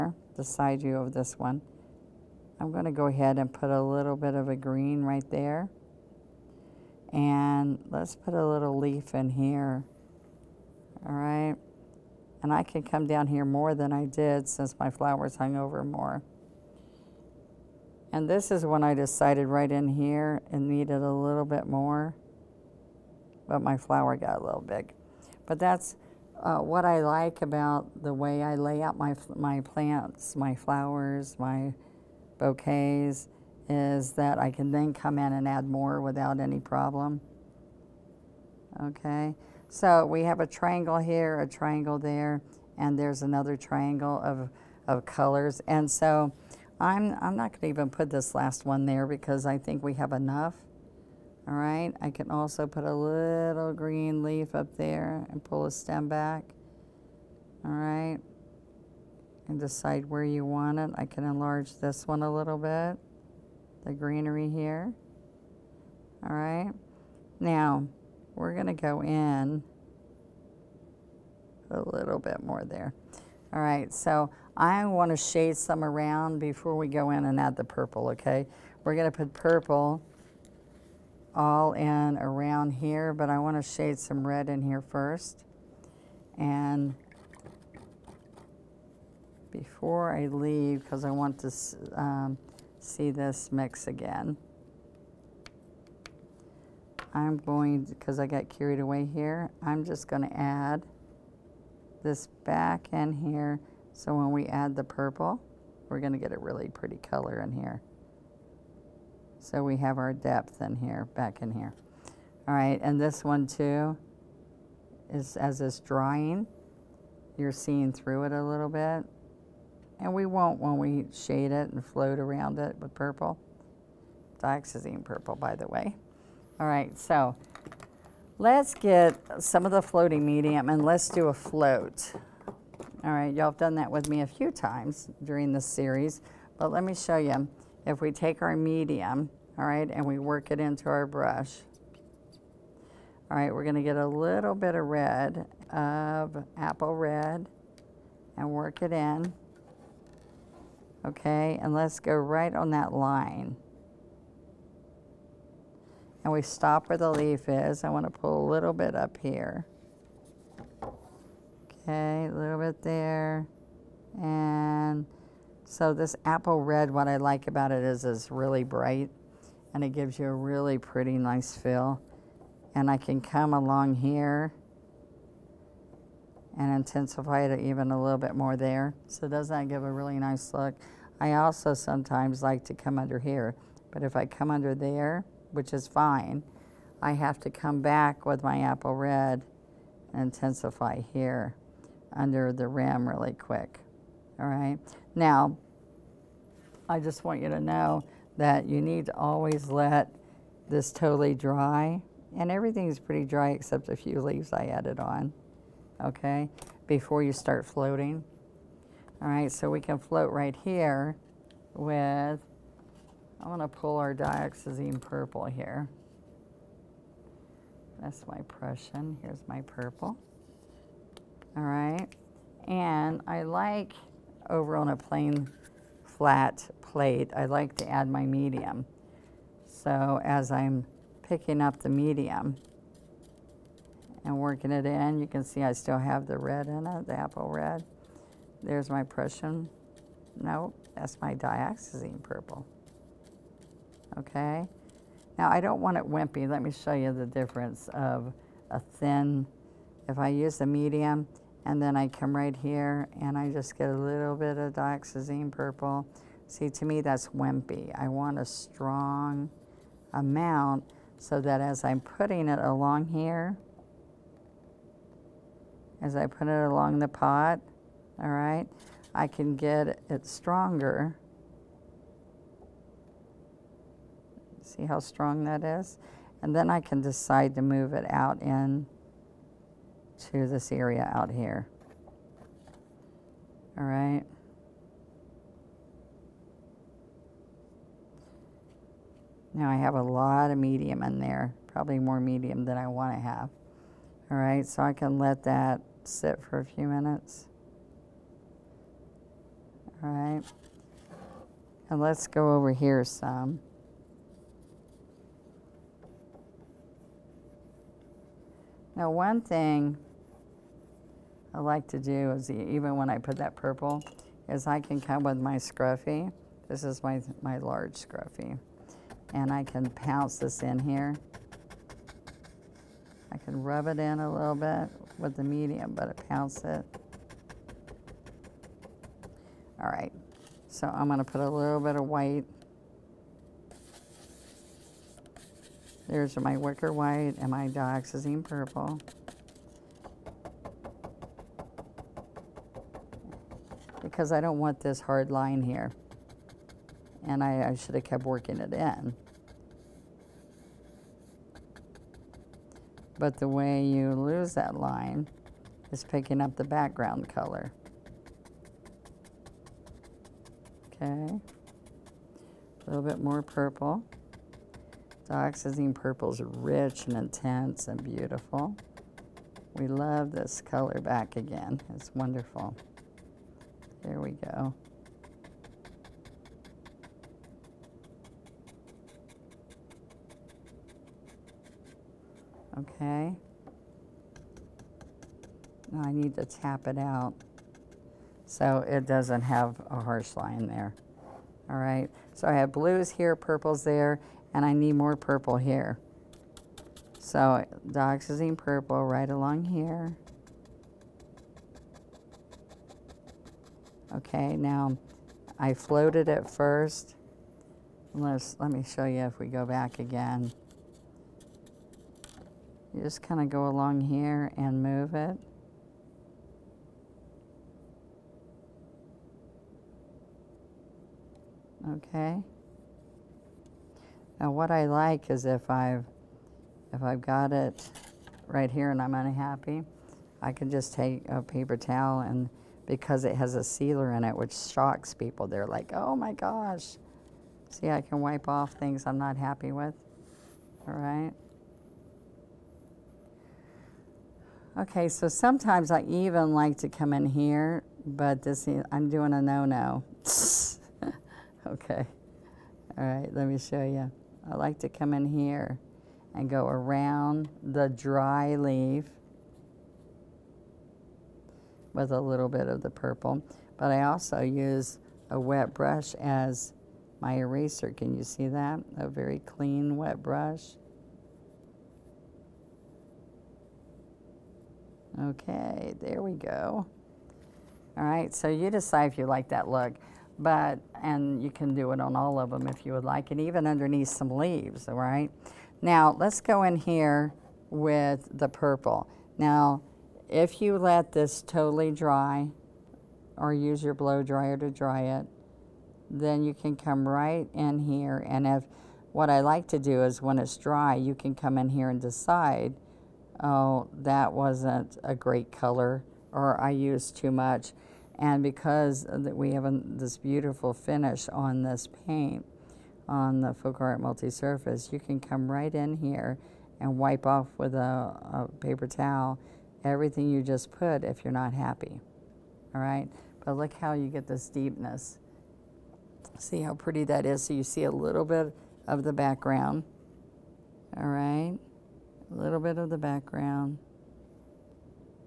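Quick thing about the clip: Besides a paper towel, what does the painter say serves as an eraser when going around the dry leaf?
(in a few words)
a wet brush.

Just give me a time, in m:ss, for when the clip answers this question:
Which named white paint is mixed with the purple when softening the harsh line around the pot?
5:36.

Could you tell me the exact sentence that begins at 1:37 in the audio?
I'm going, because I got carried away here, I'm just going to add this back in here.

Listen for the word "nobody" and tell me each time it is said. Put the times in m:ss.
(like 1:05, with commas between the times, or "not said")
not said.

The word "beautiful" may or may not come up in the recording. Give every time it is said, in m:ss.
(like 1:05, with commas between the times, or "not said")
6:08, 8:30.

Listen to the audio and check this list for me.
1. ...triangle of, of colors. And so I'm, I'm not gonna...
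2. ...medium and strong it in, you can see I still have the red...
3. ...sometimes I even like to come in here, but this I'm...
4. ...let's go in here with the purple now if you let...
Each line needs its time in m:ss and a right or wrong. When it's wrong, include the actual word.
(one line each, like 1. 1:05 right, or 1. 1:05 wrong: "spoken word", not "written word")
1. 0:43 right
2. 3:51 wrong: "working", not "strong"
3. 7:25 right
4. 8:06 right.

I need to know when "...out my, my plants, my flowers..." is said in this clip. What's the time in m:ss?
0:28.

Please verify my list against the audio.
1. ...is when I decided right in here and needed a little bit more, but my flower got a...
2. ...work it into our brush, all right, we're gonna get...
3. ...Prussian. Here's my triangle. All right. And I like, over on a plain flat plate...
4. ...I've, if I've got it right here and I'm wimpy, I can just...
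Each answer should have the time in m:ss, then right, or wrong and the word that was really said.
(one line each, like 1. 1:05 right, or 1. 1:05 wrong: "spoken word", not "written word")
1. 0:18 right
2. 2:20 right
3. 3:38 wrong: "purple", not "triangle"
4. 7:05 wrong: "unhappy", not "wimpy".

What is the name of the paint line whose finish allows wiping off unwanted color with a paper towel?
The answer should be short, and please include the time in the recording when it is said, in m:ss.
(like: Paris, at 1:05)
FolkArt Multi-Surface, at 8:33.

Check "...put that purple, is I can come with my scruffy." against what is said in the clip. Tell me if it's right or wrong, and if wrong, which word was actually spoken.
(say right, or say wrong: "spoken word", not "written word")
right.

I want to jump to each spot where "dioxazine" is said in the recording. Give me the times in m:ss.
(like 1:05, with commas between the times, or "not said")
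2:04, 3:34, 4:01, 4:14, 5:37, 6:05, 6:37.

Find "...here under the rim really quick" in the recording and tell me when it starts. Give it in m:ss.
3:11.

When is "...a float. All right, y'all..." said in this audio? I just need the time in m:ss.
2:11.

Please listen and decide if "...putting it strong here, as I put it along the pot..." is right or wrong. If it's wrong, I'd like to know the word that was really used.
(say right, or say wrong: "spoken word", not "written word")
wrong: "along", not "strong".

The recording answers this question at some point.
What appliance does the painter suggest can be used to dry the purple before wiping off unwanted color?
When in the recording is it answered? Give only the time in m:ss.
8:13.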